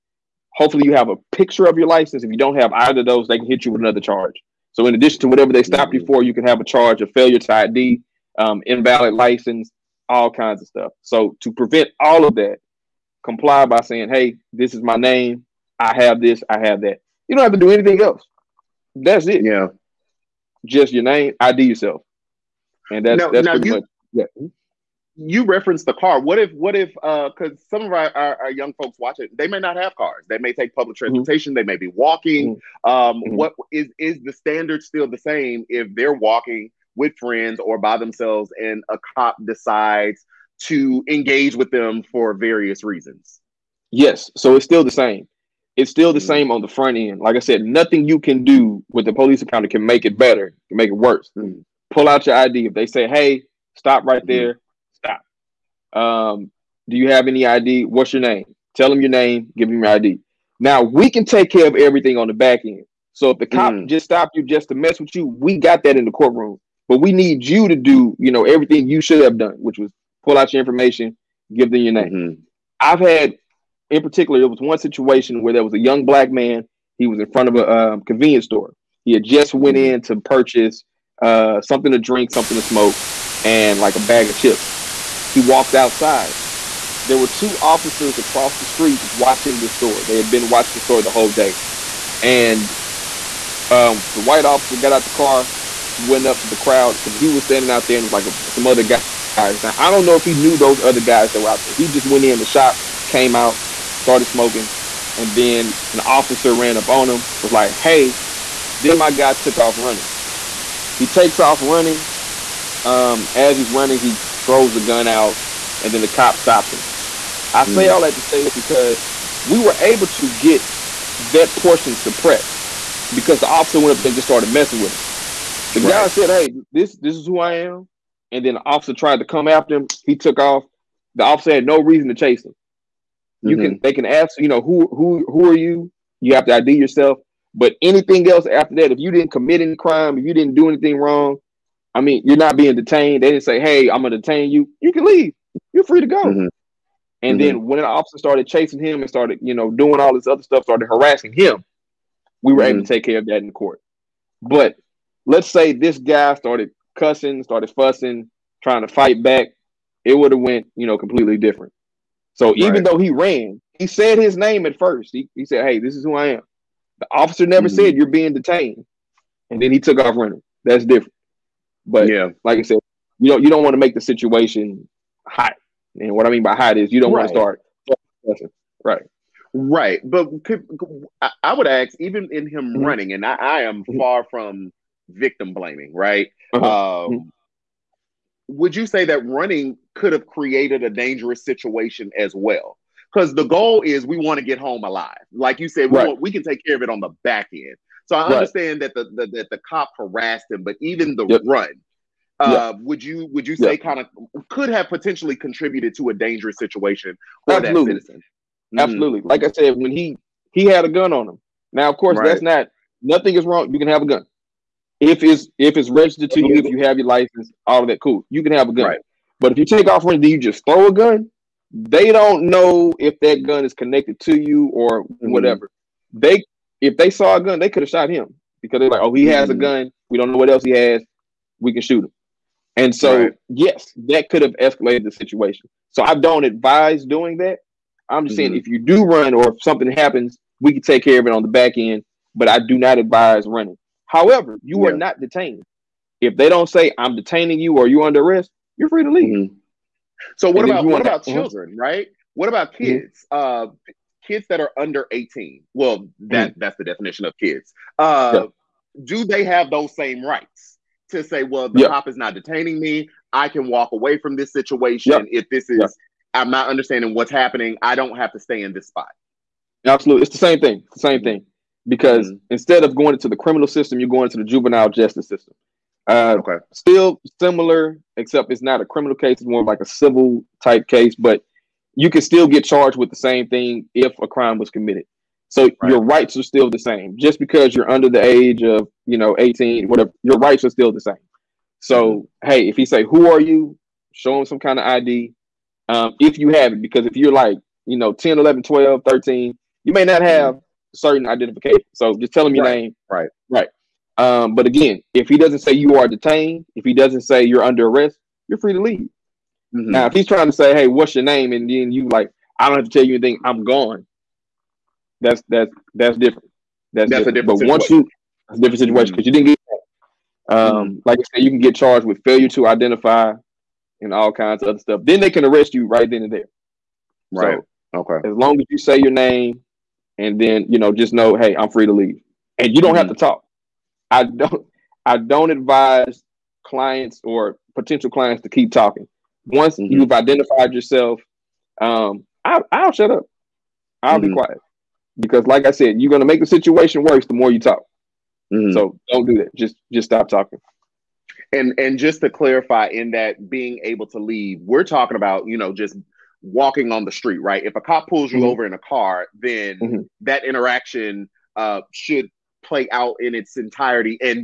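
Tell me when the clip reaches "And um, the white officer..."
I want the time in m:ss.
1:32.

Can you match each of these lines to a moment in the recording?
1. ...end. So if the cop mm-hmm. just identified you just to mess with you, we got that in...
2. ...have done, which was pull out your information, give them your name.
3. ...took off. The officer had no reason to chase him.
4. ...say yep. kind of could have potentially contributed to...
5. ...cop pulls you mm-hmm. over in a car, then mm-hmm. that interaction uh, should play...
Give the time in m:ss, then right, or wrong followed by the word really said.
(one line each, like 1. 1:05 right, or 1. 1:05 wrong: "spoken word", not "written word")
1. 1:02 wrong: "stopped", not "identified"
2. 1:09 right
3. 2:10 right
4. 3:23 right
5. 5:57 right.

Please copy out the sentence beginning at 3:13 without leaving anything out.
Because the goal is we want to get home alive.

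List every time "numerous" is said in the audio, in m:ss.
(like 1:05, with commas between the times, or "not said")
not said.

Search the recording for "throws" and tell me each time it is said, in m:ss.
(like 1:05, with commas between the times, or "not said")
1:54, 3:40.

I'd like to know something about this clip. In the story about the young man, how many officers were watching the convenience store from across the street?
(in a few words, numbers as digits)
2.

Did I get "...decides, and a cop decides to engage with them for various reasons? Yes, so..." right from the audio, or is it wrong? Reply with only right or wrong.
wrong.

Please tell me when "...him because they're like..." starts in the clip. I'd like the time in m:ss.
3:48.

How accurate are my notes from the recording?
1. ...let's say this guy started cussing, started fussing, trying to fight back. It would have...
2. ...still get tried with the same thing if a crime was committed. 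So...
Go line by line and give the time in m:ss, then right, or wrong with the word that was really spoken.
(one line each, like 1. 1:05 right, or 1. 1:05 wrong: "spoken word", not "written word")
1. 2:35 right
2. 4:42 wrong: "charged", not "tried".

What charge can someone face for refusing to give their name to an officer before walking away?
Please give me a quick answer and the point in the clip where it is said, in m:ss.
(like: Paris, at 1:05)
failure to identify, at 5:22.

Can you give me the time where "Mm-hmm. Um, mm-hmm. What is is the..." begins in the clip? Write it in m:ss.
0:32.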